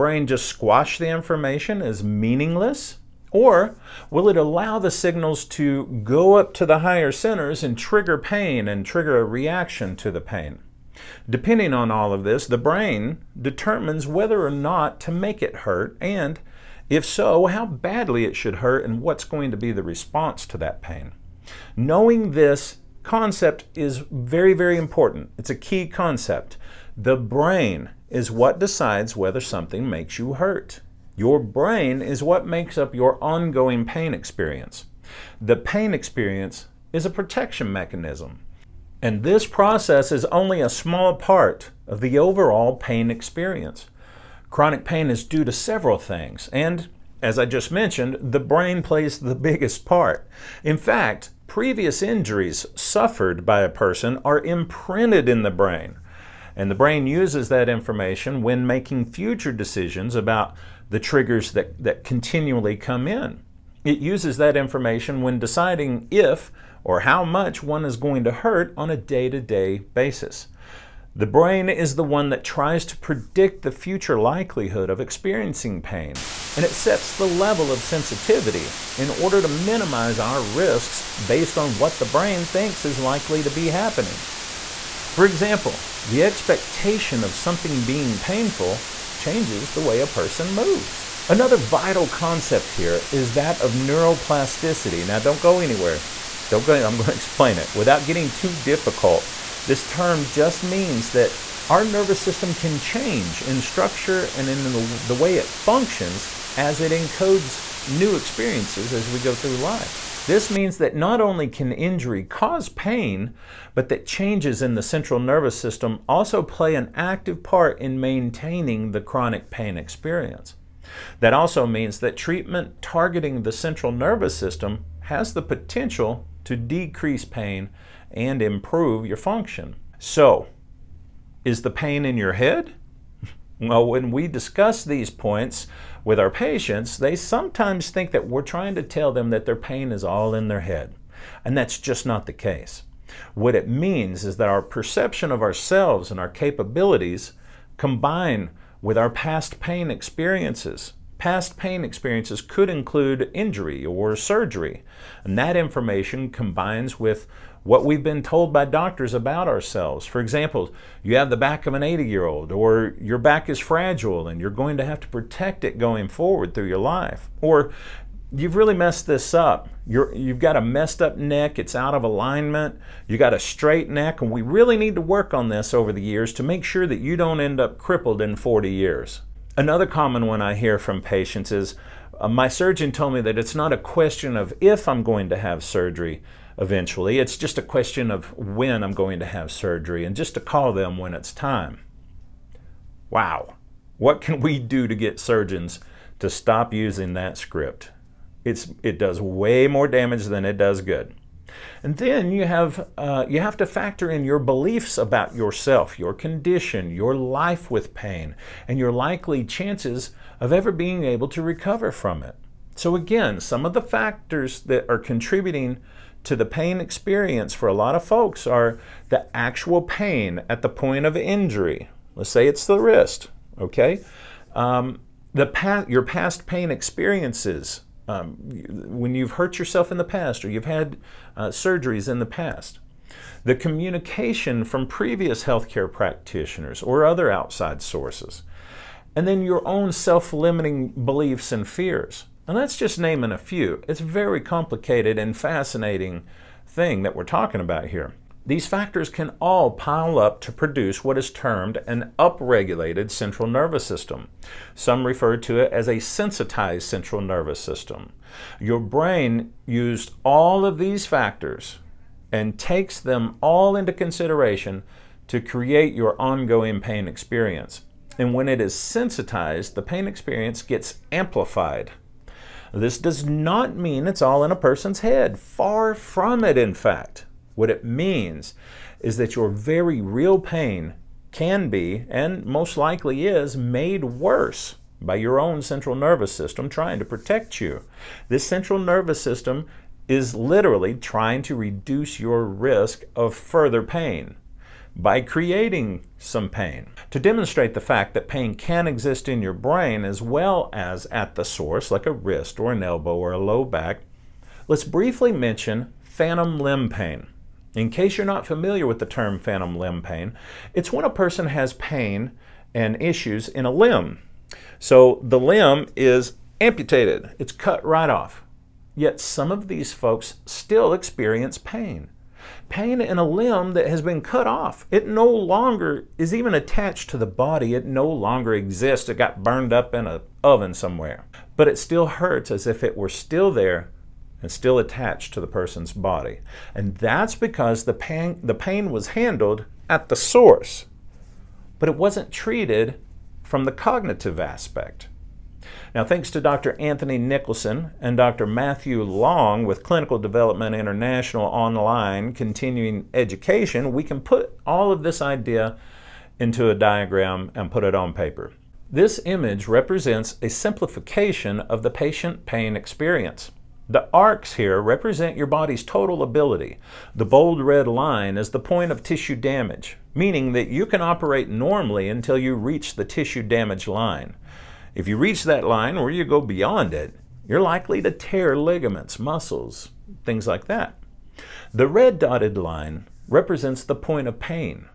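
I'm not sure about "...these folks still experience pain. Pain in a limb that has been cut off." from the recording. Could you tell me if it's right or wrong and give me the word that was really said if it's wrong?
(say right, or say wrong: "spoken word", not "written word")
right.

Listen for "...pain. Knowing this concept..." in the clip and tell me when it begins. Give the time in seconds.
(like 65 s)
20 s.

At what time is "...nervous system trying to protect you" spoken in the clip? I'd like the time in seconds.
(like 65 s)
285 s.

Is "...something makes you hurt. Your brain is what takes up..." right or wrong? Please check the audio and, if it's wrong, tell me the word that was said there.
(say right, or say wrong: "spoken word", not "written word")
wrong: "makes", not "takes".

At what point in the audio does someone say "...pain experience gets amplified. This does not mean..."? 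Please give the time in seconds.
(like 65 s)
269 s.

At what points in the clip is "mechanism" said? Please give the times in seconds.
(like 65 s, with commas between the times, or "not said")
37 s.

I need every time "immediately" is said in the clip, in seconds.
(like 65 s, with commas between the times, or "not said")
not said.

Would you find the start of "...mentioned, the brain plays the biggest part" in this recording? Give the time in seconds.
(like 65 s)
47 s.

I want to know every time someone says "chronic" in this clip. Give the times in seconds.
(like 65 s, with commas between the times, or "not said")
44 s, 118 s.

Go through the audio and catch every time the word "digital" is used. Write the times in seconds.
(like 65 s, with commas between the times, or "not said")
not said.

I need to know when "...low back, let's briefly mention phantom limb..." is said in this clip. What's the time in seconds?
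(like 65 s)
303 s.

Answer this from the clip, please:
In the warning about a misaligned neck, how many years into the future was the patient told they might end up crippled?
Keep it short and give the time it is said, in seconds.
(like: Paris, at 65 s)
40, at 178 s.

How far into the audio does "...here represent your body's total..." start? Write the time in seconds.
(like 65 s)
364 s.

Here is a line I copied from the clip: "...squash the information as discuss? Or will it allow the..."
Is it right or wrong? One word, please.
wrong.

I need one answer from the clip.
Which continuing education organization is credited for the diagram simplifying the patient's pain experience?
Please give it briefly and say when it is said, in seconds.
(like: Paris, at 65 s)
Clinical Development International, at 349 s.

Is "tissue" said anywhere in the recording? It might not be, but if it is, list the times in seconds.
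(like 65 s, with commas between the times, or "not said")
369 s, 373 s.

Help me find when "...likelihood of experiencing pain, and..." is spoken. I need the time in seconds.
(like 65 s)
74 s.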